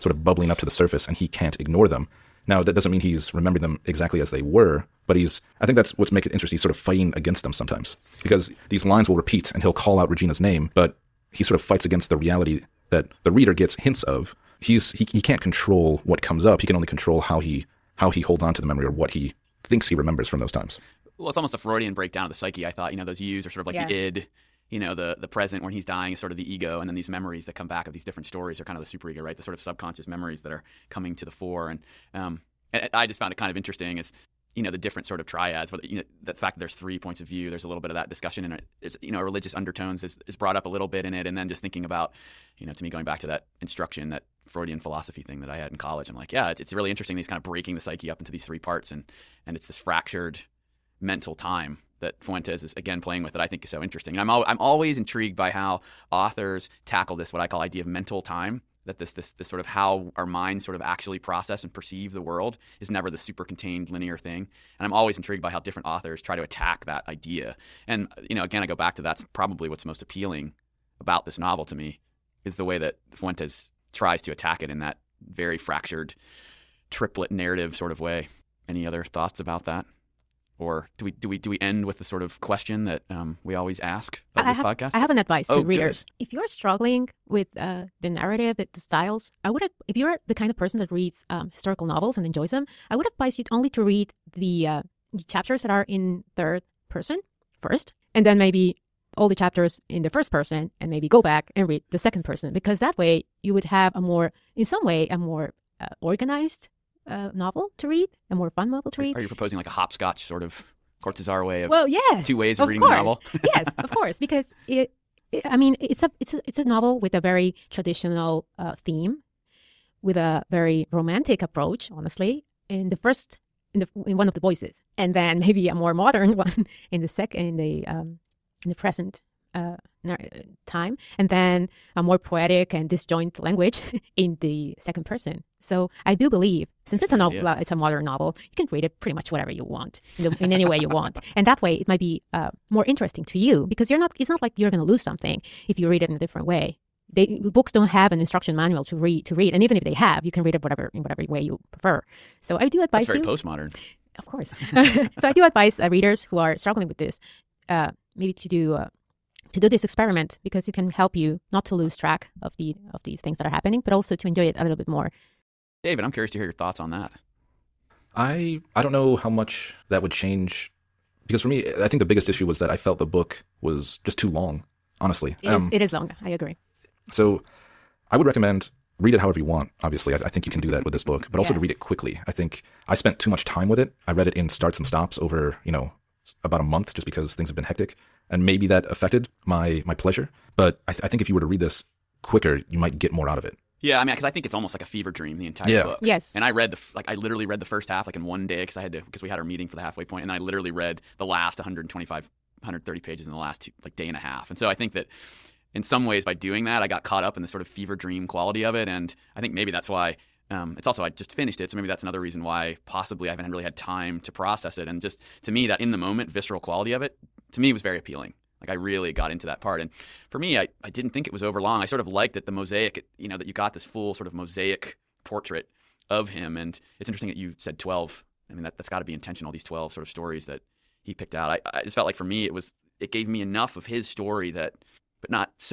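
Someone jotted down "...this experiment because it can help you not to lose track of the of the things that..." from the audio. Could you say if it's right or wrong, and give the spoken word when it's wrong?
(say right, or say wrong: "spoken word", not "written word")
right.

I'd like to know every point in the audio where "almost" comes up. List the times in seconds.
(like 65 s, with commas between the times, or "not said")
21 s, 194 s.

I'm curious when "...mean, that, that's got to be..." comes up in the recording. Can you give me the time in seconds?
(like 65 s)
228 s.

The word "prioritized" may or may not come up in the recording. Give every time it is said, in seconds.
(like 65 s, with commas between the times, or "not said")
not said.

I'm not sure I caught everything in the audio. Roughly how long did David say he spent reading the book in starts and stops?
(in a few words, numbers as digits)
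About a month.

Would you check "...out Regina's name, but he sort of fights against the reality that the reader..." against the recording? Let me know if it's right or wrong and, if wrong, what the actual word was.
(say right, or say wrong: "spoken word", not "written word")
right.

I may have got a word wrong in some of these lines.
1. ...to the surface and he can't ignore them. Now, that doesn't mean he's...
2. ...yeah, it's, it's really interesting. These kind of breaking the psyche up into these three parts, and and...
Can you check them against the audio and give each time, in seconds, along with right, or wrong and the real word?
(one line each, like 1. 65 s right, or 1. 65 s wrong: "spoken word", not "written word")
1. 0 s right
2. 46 s right.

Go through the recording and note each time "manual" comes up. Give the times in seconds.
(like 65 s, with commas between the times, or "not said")
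148 s.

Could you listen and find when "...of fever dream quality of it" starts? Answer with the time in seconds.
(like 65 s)
207 s.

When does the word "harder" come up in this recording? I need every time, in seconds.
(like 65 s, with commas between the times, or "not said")
not said.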